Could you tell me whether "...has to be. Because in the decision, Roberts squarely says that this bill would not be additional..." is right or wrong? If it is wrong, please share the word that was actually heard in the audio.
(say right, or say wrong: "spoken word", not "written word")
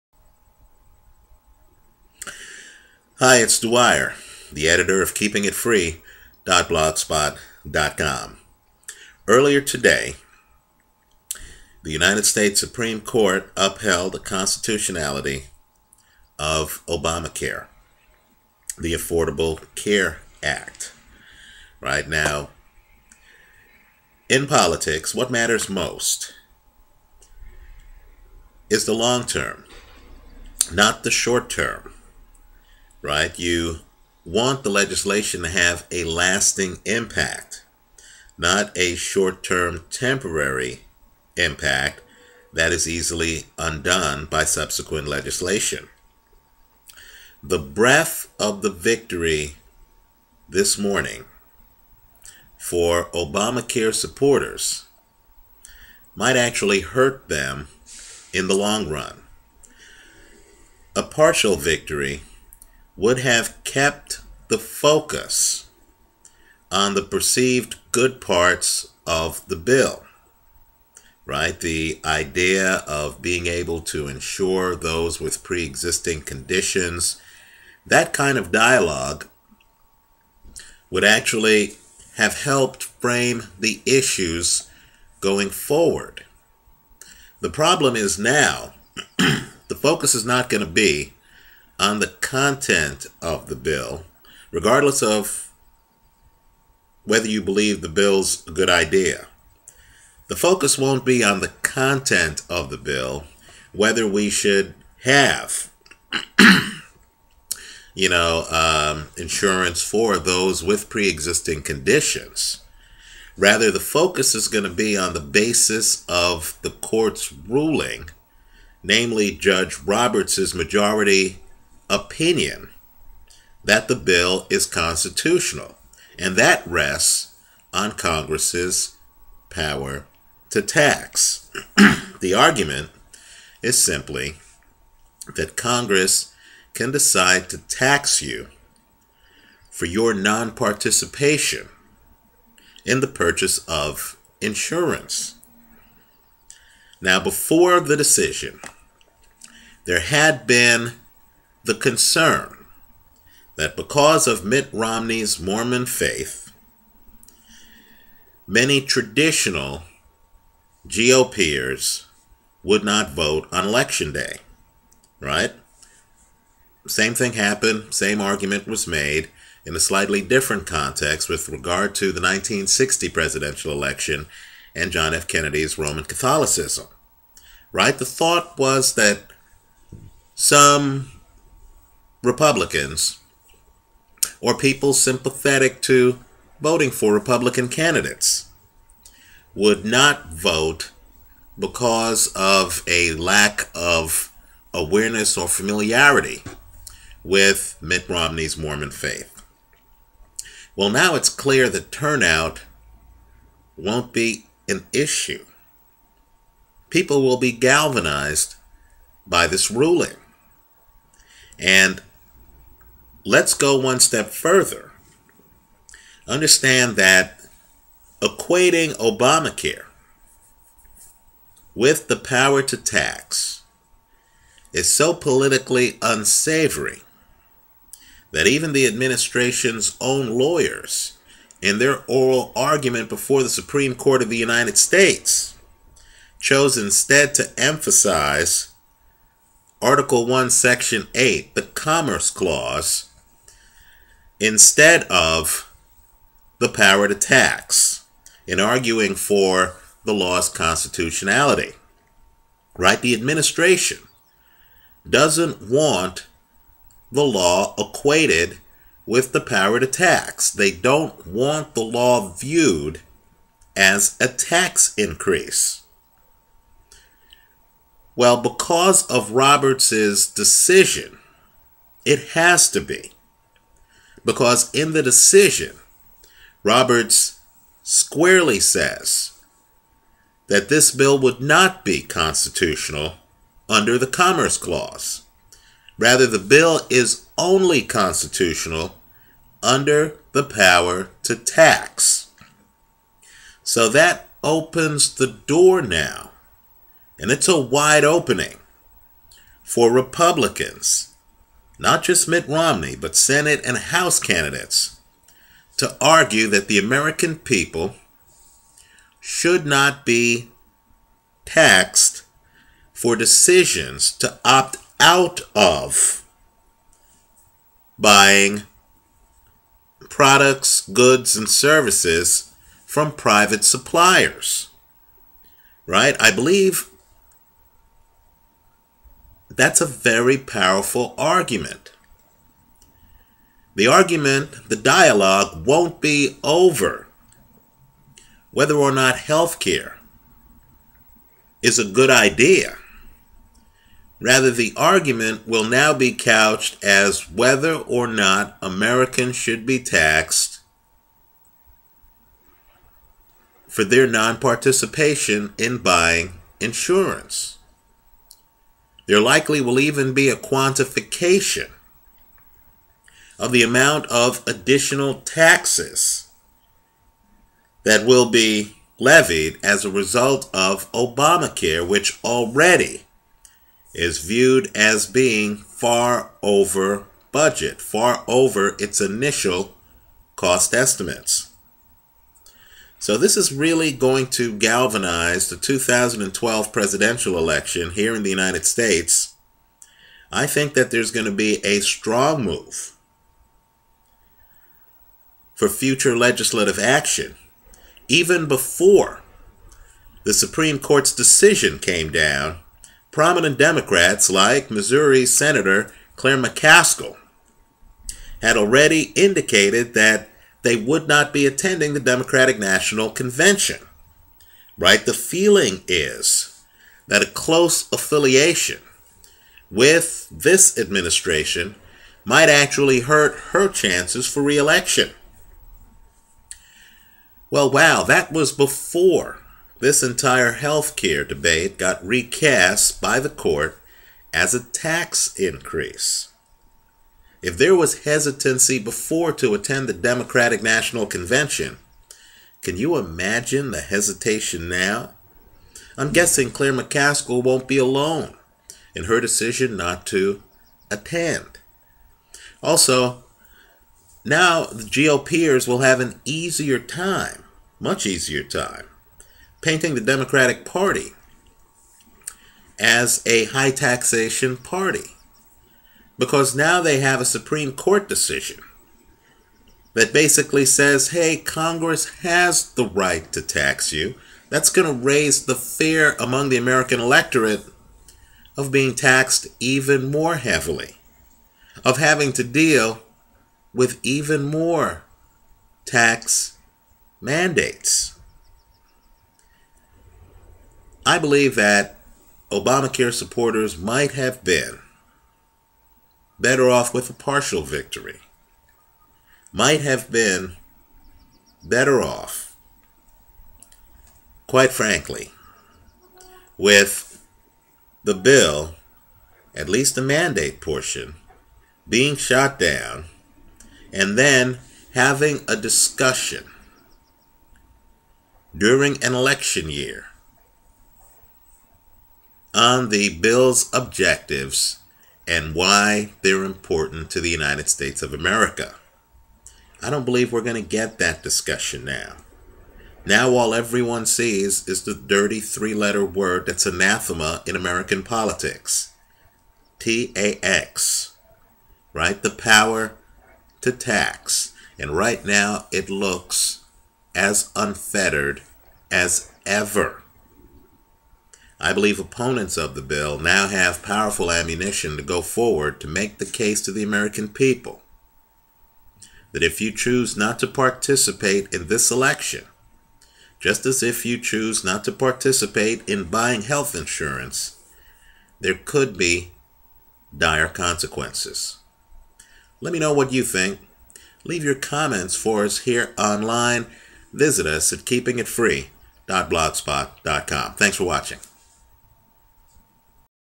wrong: "constitutional", not "additional".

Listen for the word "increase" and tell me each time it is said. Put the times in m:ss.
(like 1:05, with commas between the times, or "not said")
4:24, 7:15.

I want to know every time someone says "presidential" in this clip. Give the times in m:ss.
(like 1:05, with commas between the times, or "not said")
2:53, 6:26.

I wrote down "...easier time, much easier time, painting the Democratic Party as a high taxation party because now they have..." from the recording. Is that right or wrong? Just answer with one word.
right.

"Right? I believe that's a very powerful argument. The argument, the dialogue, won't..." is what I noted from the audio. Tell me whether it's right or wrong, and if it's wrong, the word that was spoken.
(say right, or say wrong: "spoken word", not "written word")
right.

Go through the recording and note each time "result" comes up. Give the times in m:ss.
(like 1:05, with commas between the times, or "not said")
6:09.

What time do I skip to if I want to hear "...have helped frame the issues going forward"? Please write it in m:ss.
1:22.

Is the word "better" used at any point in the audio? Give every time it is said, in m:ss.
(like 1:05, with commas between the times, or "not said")
8:16, 8:21.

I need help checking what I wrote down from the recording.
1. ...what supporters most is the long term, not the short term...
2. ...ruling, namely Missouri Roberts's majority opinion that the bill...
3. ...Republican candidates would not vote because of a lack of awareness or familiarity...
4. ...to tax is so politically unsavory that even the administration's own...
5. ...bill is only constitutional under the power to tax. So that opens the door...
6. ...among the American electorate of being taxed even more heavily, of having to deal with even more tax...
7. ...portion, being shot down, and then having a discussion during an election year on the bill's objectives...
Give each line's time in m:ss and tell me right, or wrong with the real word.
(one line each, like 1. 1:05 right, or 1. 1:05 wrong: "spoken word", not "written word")
1. 0:25 wrong: "matters", not "supporters"
2. 1:57 wrong: "Judge", not "Missouri"
3. 3:07 right
4. 3:42 right
5. 4:46 right
6. 7:56 right
7. 8:30 right.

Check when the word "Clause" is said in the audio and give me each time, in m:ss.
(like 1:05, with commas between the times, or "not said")
4:02, 4:44.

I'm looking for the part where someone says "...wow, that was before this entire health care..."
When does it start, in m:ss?
7:07.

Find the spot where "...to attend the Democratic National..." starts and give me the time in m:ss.
7:19.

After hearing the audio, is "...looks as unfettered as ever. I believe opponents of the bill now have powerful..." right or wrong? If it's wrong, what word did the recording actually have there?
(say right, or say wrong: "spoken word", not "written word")
right.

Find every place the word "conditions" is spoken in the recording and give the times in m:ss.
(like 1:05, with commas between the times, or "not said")
1:16, 1:51.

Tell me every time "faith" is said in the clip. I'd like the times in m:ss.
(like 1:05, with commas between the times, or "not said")
2:35, 3:18.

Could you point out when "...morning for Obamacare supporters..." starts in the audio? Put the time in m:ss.
0:50.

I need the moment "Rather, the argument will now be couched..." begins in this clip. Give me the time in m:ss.
5:44.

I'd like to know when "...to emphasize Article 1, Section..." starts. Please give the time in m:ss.
3:57.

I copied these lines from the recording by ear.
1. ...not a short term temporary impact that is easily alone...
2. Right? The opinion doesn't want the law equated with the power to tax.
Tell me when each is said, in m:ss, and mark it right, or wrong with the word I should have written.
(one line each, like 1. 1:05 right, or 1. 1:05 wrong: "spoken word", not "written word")
1. 0:38 wrong: "undone", not "alone"
2. 4:12 wrong: "administration", not "opinion".